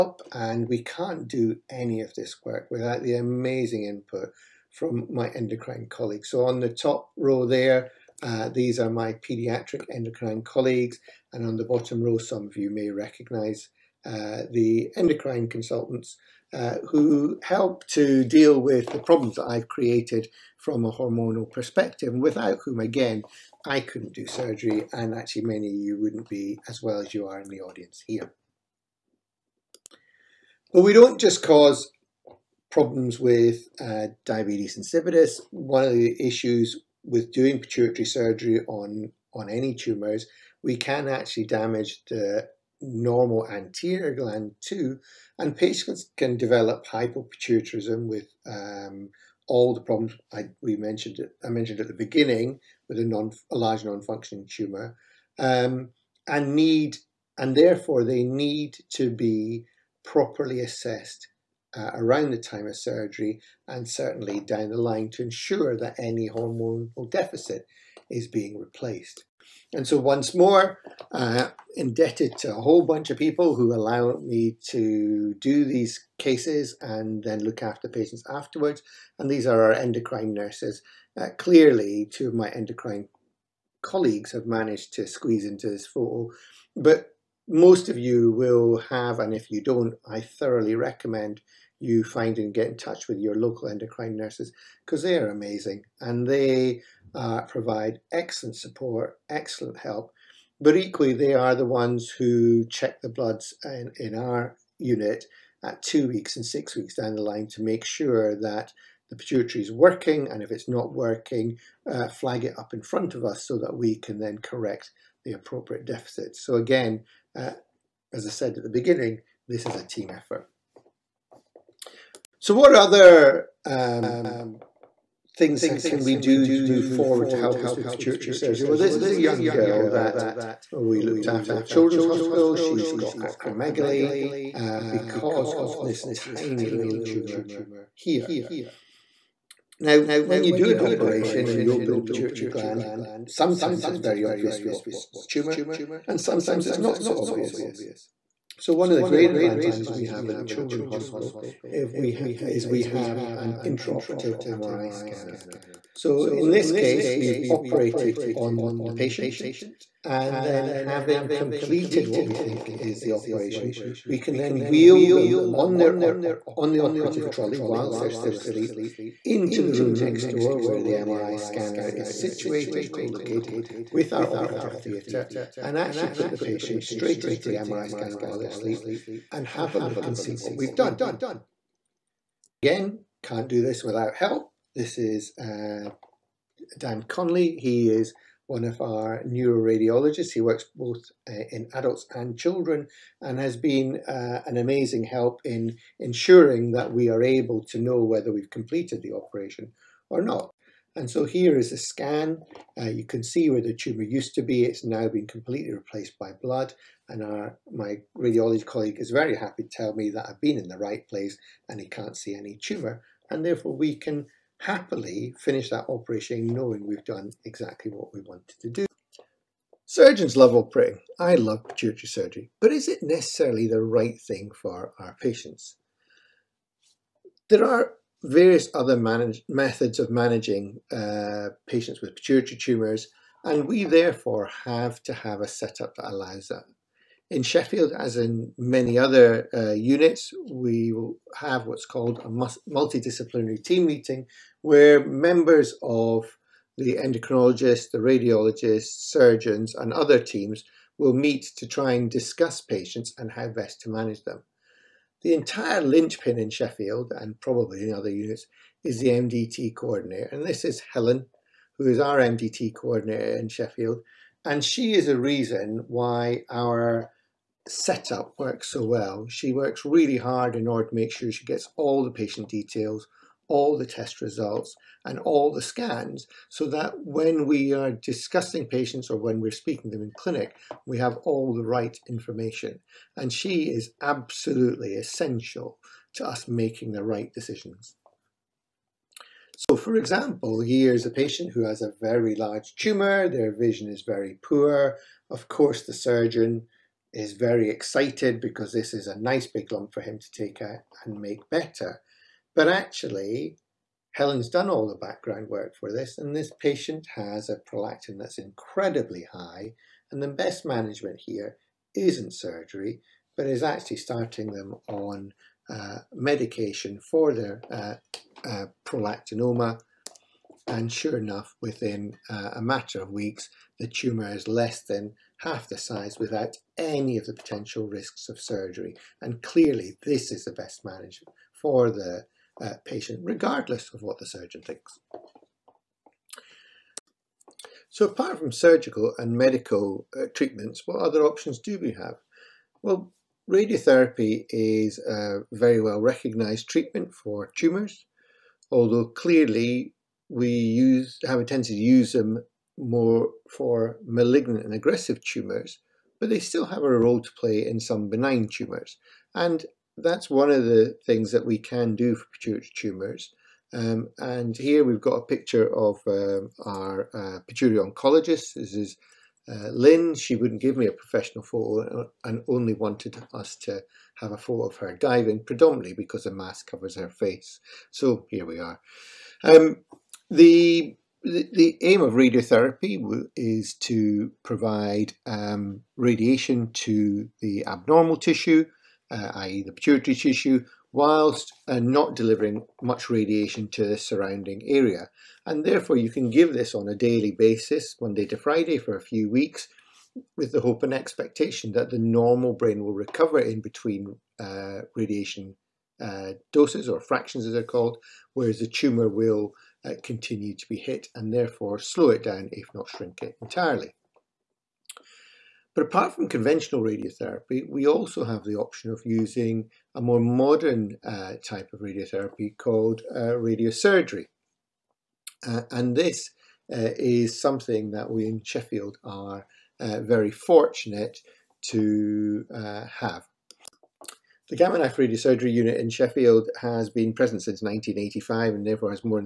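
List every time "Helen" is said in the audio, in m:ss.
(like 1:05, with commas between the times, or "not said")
4:20, 5:04.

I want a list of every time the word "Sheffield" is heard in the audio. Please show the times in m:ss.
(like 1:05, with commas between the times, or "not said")
3:57, 4:16, 4:23, 7:08, 7:15.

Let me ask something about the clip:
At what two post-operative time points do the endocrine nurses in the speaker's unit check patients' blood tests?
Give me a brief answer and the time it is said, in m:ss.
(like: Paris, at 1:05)
2 weeks and 6 weeks, at 1:45.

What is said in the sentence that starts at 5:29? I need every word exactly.
And clearly, this is the best management for the uh, patient, regardless of what the surgeon thinks.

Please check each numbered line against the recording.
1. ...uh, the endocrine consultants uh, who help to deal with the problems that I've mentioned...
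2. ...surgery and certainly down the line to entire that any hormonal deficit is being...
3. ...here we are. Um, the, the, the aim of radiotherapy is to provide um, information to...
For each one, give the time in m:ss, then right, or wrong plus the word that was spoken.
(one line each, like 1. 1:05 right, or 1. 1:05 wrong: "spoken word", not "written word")
1. 0:14 wrong: "created", not "mentioned"
2. 1:02 wrong: "ensure", not "entire"
3. 6:18 wrong: "radiation", not "information".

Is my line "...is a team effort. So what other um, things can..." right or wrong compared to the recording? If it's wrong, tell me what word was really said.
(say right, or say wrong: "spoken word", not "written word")
right.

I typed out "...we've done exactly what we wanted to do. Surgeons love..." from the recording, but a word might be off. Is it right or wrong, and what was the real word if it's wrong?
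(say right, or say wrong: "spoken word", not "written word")
right.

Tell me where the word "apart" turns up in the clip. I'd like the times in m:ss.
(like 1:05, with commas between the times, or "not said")
5:38, 6:55.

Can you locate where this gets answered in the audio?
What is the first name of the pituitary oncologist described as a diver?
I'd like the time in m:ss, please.
6:09.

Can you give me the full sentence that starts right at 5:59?
And that's one of the things that we can do for pituitary tumours.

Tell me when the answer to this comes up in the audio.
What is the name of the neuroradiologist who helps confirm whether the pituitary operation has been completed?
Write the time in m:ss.
3:06.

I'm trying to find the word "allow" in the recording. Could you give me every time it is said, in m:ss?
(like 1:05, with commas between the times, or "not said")
1:13, 3:56.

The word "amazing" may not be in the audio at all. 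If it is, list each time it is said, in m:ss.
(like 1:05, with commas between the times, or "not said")
0:03, 1:35, 3:14.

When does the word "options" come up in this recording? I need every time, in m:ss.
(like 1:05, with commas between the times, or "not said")
5:41, 6:58.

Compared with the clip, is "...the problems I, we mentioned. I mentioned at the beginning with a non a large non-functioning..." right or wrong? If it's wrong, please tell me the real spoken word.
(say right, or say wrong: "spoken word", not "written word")
right.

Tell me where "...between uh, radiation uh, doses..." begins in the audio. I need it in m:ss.
6:43.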